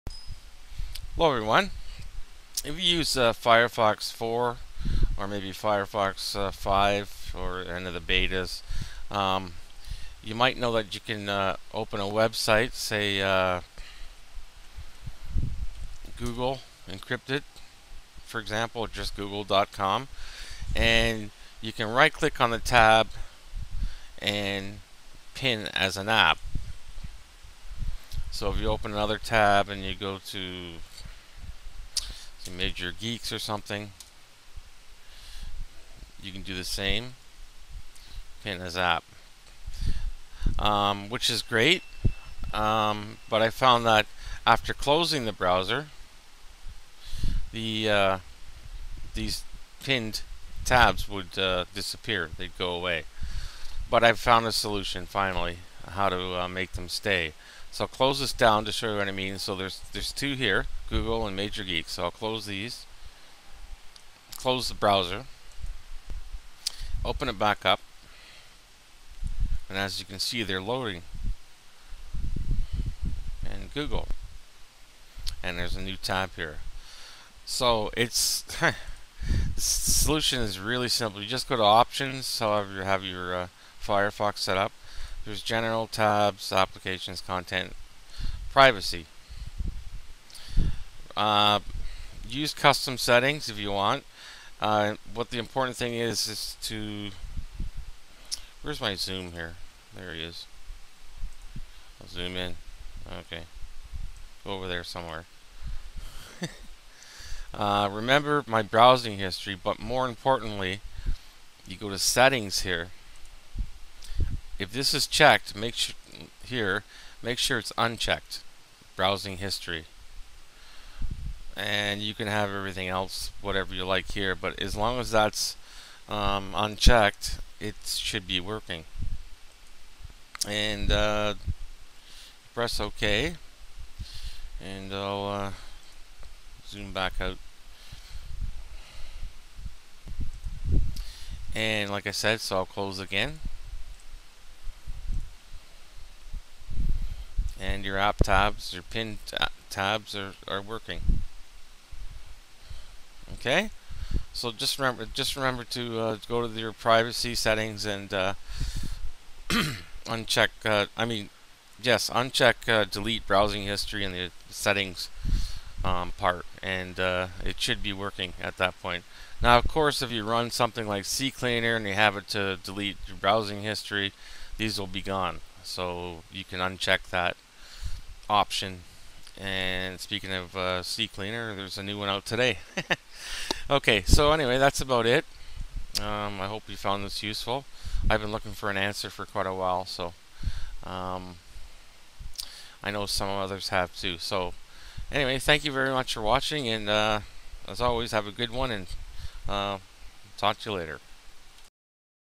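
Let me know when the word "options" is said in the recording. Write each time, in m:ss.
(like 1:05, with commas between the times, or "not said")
1:21, 2:58.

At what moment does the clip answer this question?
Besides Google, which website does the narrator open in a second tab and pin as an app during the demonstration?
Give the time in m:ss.
0:32.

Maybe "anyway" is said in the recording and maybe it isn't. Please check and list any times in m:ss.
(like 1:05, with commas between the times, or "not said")
3:04, 3:15.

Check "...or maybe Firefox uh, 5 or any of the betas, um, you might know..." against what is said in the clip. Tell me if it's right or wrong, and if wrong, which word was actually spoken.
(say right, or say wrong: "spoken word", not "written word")
right.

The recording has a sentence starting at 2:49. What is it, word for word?
Now, of course, if you run something like CCleaner and you have it to delete your browsing history, these will be gone.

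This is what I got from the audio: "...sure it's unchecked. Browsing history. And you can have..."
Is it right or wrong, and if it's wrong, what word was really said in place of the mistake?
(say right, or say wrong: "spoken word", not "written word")
right.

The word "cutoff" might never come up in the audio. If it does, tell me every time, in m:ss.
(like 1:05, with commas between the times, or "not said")
not said.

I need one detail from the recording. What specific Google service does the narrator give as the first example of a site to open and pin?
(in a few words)
Google Encrypted.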